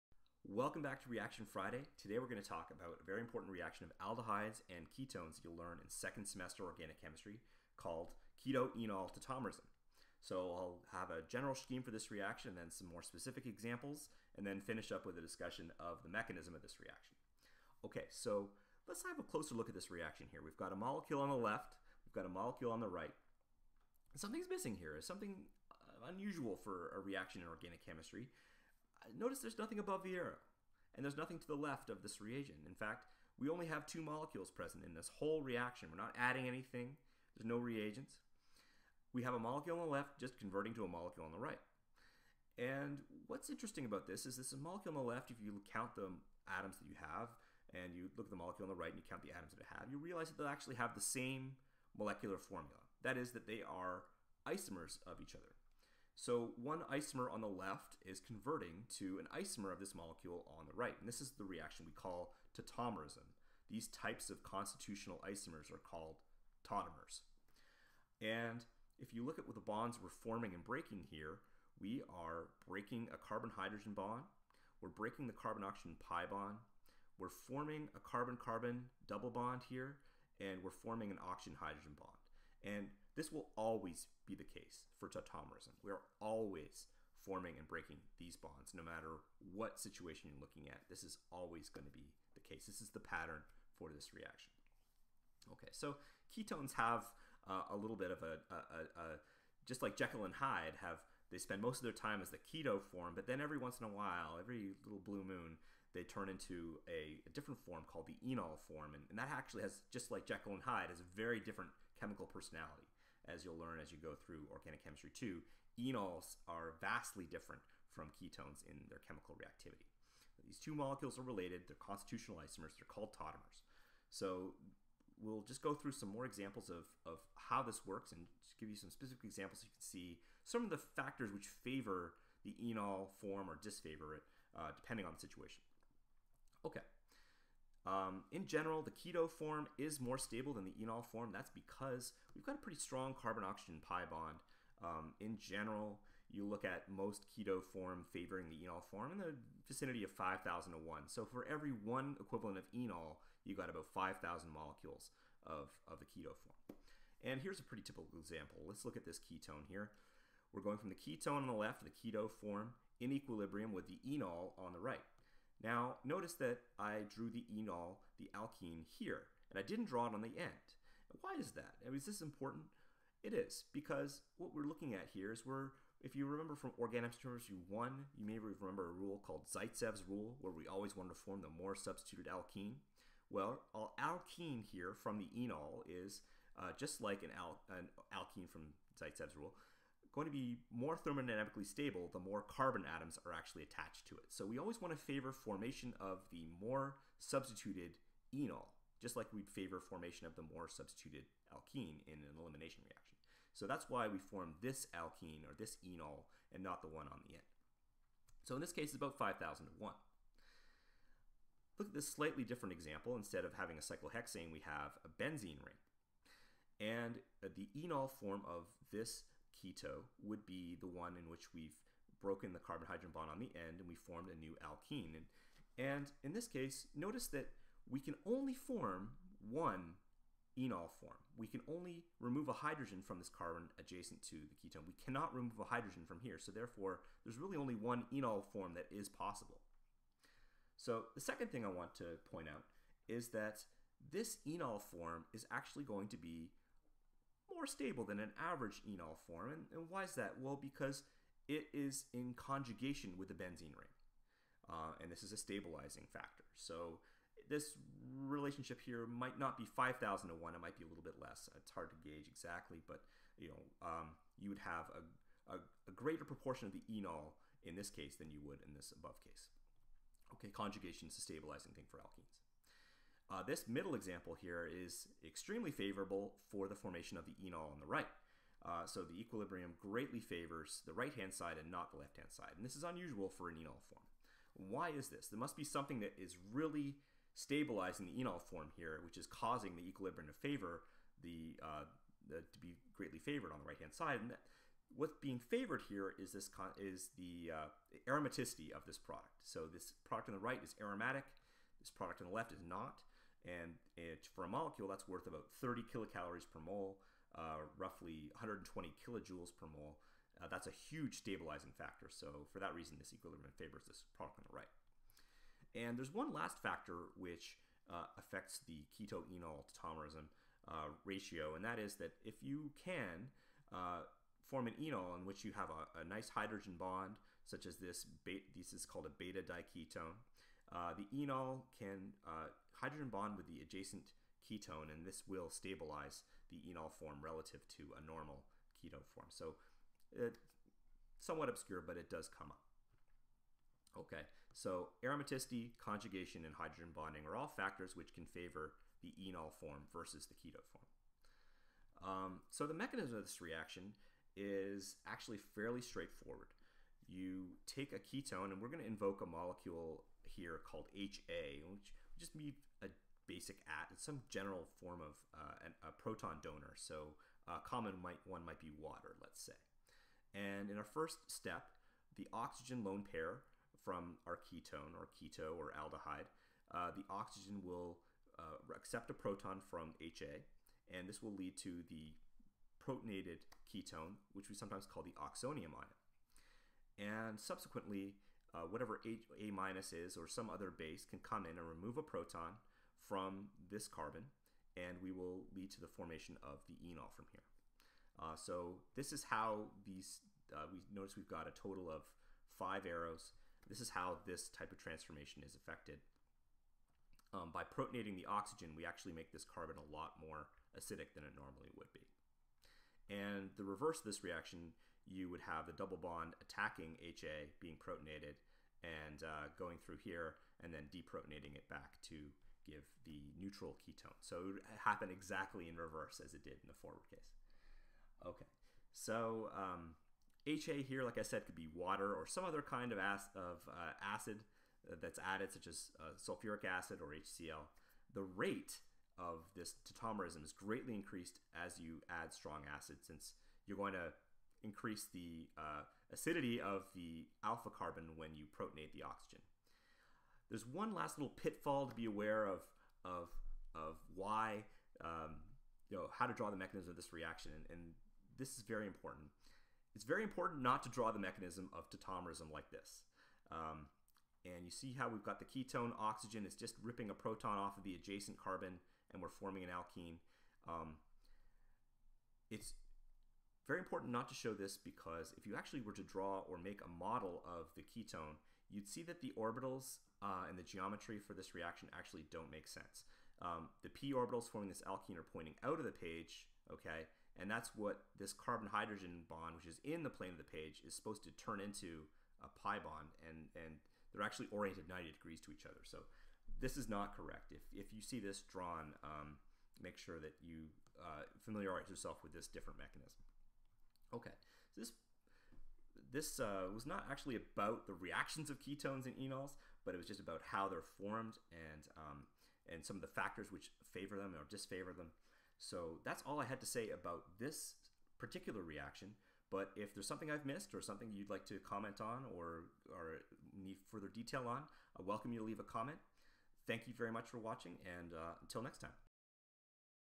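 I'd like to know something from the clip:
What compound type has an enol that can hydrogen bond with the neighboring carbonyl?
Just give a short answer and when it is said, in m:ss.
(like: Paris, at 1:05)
Beta diketone, at 5:29.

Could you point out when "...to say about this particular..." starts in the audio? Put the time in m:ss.
8:36.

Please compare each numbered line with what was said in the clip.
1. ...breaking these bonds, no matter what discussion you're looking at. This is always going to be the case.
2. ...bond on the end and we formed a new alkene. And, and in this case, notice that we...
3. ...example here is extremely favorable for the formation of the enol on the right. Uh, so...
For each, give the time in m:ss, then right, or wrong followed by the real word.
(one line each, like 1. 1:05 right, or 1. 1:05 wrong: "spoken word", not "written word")
1. 1:27 wrong: "situation", not "discussion"
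2. 3:43 right
3. 4:33 right.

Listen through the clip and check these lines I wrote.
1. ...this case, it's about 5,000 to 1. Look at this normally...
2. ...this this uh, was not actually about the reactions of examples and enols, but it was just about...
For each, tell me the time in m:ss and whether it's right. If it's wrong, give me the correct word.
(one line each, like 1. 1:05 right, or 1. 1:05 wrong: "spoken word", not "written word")
1. 3:28 wrong: "slightly", not "normally"
2. 8:24 wrong: "ketones", not "examples".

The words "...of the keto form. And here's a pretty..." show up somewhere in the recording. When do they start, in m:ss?
2:35.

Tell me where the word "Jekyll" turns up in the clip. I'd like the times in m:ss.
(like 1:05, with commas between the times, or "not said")
1:39, 1:50.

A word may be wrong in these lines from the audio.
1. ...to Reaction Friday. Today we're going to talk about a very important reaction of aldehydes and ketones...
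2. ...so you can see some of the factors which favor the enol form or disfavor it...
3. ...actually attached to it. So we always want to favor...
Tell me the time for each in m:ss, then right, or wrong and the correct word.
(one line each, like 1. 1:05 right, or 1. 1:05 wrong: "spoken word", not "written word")
1. 0:01 right
2. 2:09 right
3. 3:13 right.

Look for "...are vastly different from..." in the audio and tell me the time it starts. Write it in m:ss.
1:56.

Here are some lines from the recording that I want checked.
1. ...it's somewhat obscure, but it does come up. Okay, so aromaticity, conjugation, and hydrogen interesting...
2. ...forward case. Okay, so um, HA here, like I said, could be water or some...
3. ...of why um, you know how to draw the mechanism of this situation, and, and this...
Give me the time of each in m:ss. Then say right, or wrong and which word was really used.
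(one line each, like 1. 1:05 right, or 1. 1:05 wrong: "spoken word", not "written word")
1. 5:40 wrong: "bonding", not "interesting"
2. 7:06 right
3. 7:33 wrong: "reaction", not "situation".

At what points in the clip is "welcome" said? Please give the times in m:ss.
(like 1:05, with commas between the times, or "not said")
0:00, 8:45.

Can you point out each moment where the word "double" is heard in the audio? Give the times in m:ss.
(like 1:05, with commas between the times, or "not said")
1:19, 6:55.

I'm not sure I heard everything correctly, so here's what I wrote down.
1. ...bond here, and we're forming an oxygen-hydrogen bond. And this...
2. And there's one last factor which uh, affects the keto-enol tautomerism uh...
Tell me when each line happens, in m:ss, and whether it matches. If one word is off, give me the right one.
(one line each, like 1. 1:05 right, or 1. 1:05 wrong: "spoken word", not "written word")
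1. 1:19 right
2. 5:15 right.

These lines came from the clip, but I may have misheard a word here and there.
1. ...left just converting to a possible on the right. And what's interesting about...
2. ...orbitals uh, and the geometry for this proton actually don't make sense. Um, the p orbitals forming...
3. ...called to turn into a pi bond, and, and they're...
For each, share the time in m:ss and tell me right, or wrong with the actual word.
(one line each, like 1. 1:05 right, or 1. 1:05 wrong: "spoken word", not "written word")
1. 0:39 wrong: "molecule", not "possible"
2. 7:59 wrong: "reaction", not "proton"
3. 8:10 wrong: "supposed", not "called".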